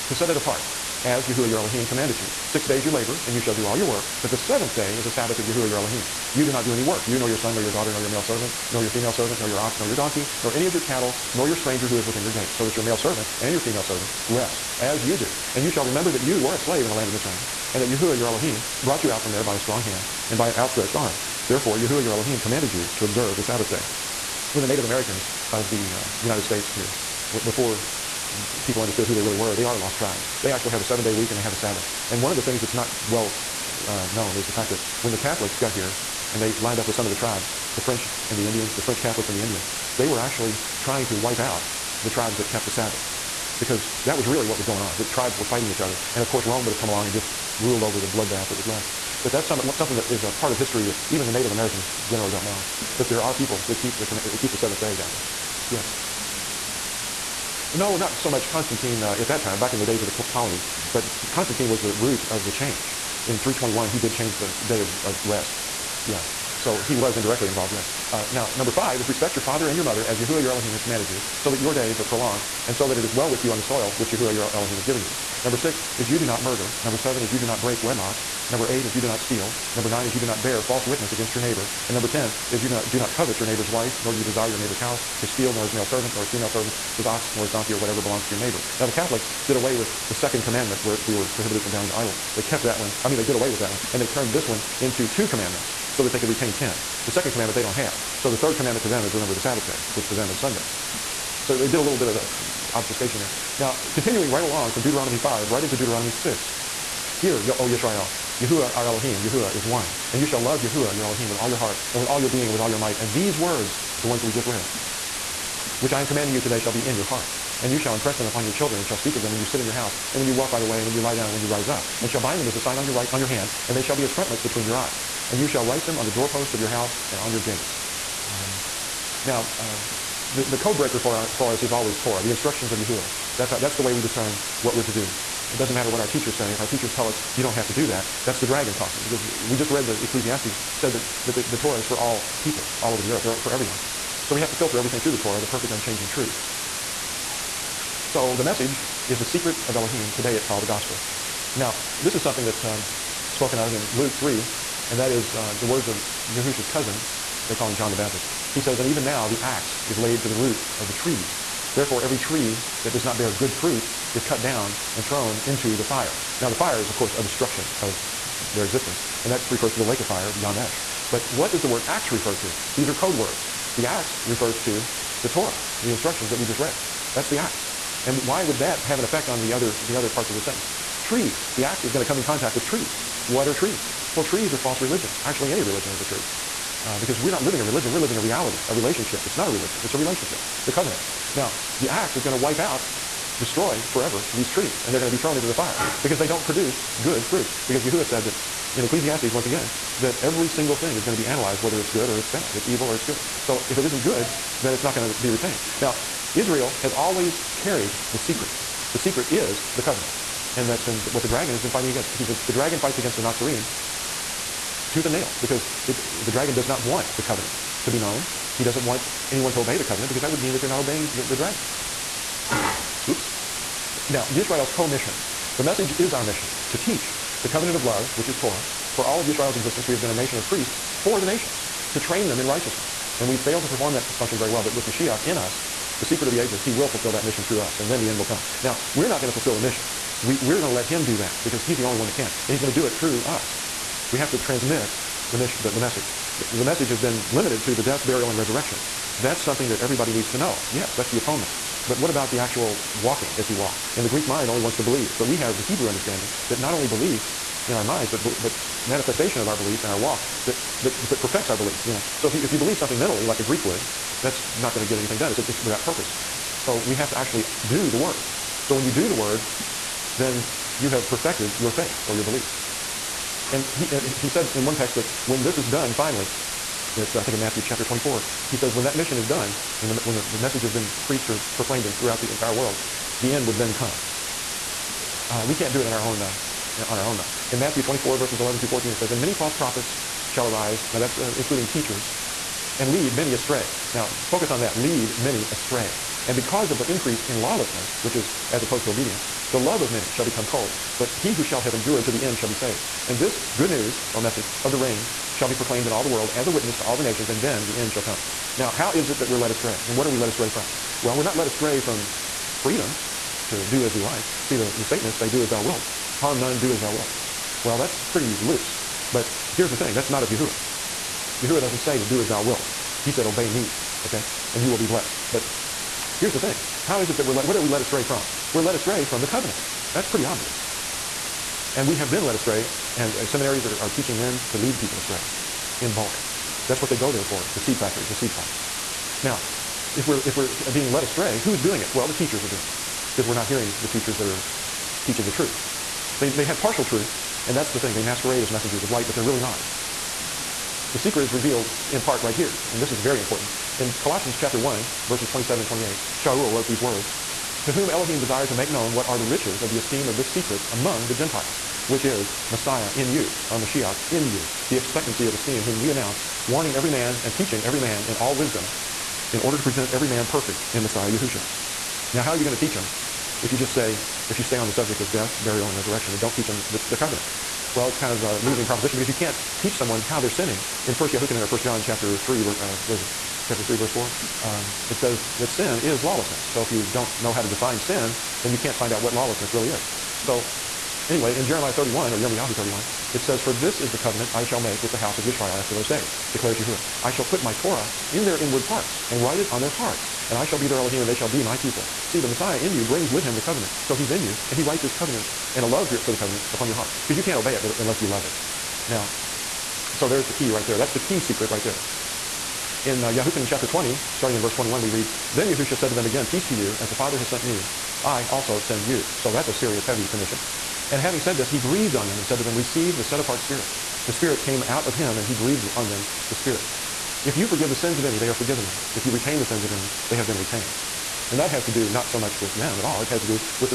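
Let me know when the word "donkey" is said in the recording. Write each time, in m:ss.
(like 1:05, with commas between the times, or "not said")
0:09, 1:27.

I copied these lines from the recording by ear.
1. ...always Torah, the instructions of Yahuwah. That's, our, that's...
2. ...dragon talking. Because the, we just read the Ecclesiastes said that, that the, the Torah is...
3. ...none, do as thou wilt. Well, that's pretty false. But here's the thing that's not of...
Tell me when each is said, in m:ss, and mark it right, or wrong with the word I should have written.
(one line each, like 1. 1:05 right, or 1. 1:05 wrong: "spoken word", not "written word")
1. 2:11 right
2. 2:18 right
3. 5:16 wrong: "loose", not "false".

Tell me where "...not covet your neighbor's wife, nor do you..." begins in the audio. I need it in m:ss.
1:22.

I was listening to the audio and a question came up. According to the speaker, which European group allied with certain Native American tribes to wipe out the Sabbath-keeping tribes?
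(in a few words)
French Catholics.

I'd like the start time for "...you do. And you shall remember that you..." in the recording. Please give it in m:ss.
0:15.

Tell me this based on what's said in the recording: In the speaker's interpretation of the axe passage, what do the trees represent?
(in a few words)
False religions.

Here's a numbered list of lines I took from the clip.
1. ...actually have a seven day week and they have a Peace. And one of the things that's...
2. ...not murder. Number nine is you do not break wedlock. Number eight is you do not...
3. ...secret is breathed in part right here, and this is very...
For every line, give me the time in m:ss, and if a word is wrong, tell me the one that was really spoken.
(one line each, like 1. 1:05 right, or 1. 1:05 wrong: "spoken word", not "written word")
1. 0:30 wrong: "Sabbath", not "Peace"
2. 1:16 wrong: "seven", not "nine"
3. 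5:50 wrong: "revealed", not "breathed".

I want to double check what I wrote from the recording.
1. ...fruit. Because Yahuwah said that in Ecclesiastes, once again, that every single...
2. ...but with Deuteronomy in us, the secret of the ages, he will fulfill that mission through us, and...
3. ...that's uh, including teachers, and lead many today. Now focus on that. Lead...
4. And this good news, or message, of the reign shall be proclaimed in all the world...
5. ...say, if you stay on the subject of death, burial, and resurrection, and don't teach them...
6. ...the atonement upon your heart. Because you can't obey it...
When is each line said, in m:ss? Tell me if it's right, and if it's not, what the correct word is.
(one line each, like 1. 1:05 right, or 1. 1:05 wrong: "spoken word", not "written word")
1. 3:17 right
2. 3:54 wrong: "Mashiach", not "Deuteronomy"
3. 4:50 wrong: "astray", not "today"
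4. 5:03 right
5. 6:13 right
6. 6:46 wrong: "covenant", not "atonement".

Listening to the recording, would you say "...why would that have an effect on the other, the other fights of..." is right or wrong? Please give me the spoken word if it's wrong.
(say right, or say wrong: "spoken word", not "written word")
wrong: "parts", not "fights".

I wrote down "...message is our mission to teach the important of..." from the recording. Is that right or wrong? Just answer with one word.
wrong.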